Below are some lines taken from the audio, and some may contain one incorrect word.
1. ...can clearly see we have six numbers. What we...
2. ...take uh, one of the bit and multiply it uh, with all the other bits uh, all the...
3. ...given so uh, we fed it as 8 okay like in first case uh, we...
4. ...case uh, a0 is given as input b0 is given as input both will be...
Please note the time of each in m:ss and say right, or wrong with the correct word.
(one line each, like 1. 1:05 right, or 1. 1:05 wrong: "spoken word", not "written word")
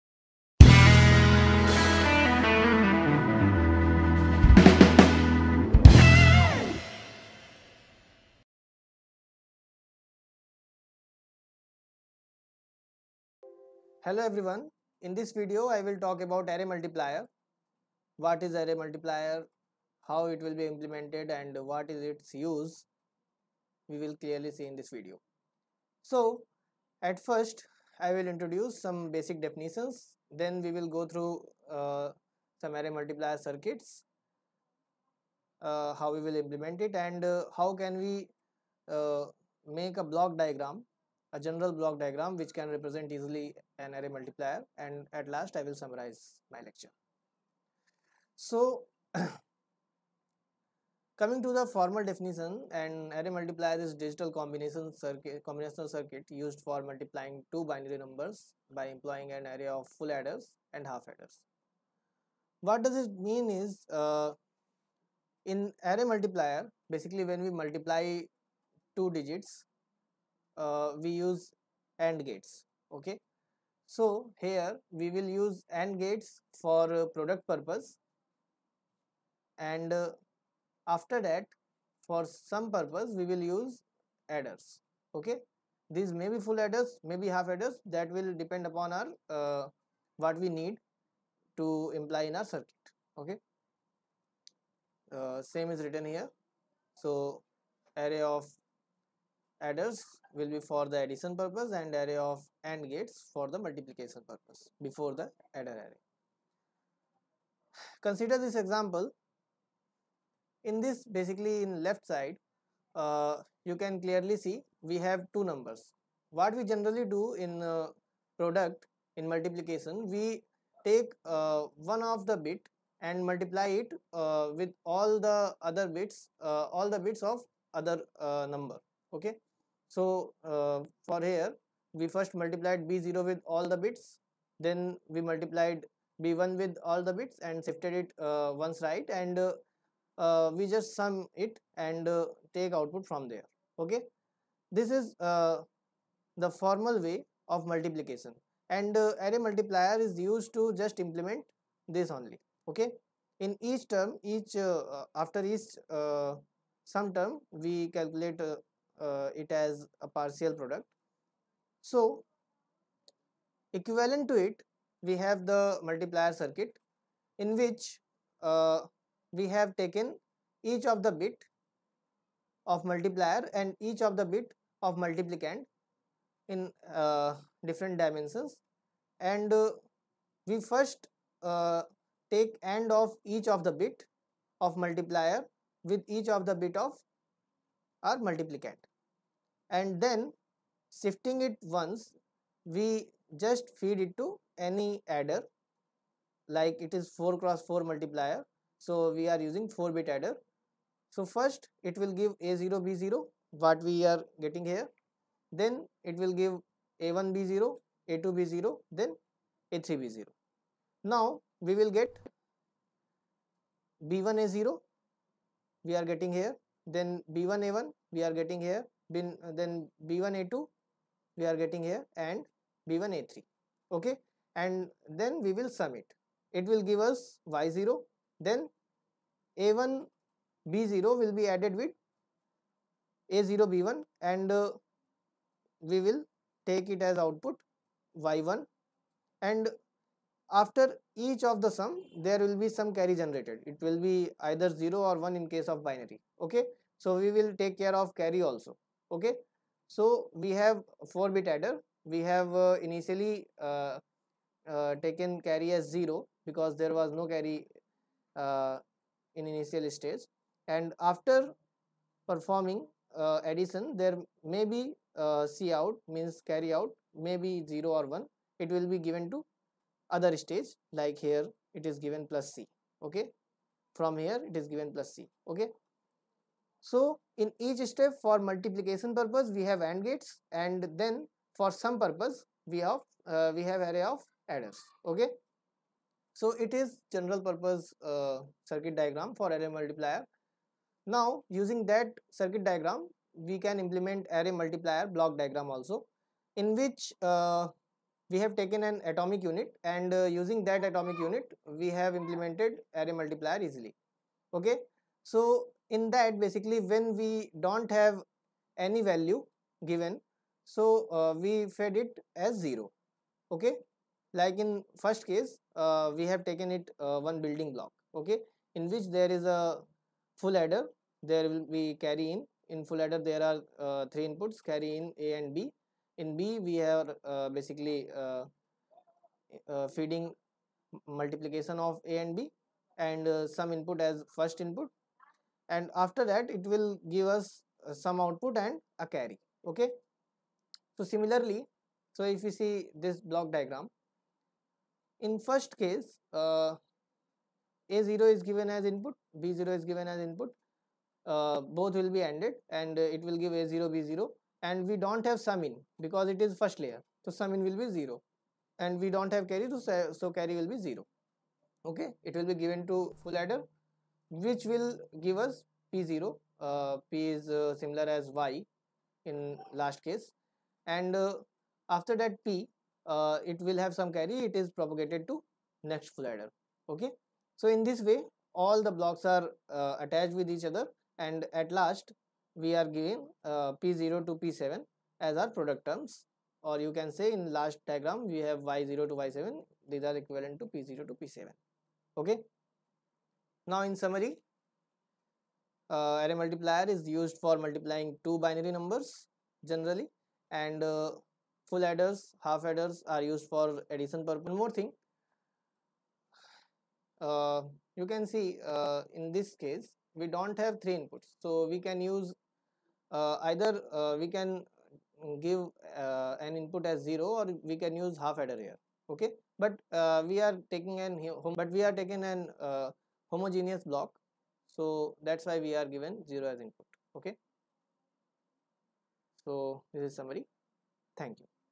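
1. 1:53 wrong: "two", not "six"
2. 2:00 right
3. 5:09 wrong: "0", not "8"
4. 5:45 right.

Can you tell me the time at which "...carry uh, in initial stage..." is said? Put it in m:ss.
4:17.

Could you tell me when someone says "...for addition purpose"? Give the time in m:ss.
6:43.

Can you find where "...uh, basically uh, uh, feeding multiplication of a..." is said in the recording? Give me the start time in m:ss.
5:27.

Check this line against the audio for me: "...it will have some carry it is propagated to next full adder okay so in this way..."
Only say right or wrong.
right.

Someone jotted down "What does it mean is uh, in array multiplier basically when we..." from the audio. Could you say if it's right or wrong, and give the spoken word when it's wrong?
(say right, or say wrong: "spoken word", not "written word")
right.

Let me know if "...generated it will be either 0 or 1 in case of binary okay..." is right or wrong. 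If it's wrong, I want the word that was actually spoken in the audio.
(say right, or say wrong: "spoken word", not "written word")
right.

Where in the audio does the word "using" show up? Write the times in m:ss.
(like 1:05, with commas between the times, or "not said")
3:19, 4:51, 5:00.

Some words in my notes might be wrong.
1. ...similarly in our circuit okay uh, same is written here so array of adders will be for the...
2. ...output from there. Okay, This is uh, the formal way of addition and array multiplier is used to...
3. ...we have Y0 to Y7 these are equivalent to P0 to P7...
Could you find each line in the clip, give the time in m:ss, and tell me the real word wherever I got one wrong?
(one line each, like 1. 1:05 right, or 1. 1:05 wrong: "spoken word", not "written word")
1. 1:31 wrong: "imply", not "similarly"
2. 2:22 wrong: "multiplication", not "addition"
3. 6:28 right.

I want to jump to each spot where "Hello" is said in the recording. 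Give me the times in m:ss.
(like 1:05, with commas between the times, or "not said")
0:14.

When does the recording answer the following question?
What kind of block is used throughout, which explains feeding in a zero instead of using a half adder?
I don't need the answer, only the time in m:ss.
7:03.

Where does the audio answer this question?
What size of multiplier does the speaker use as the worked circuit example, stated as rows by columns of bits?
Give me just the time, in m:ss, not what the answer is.
3:17.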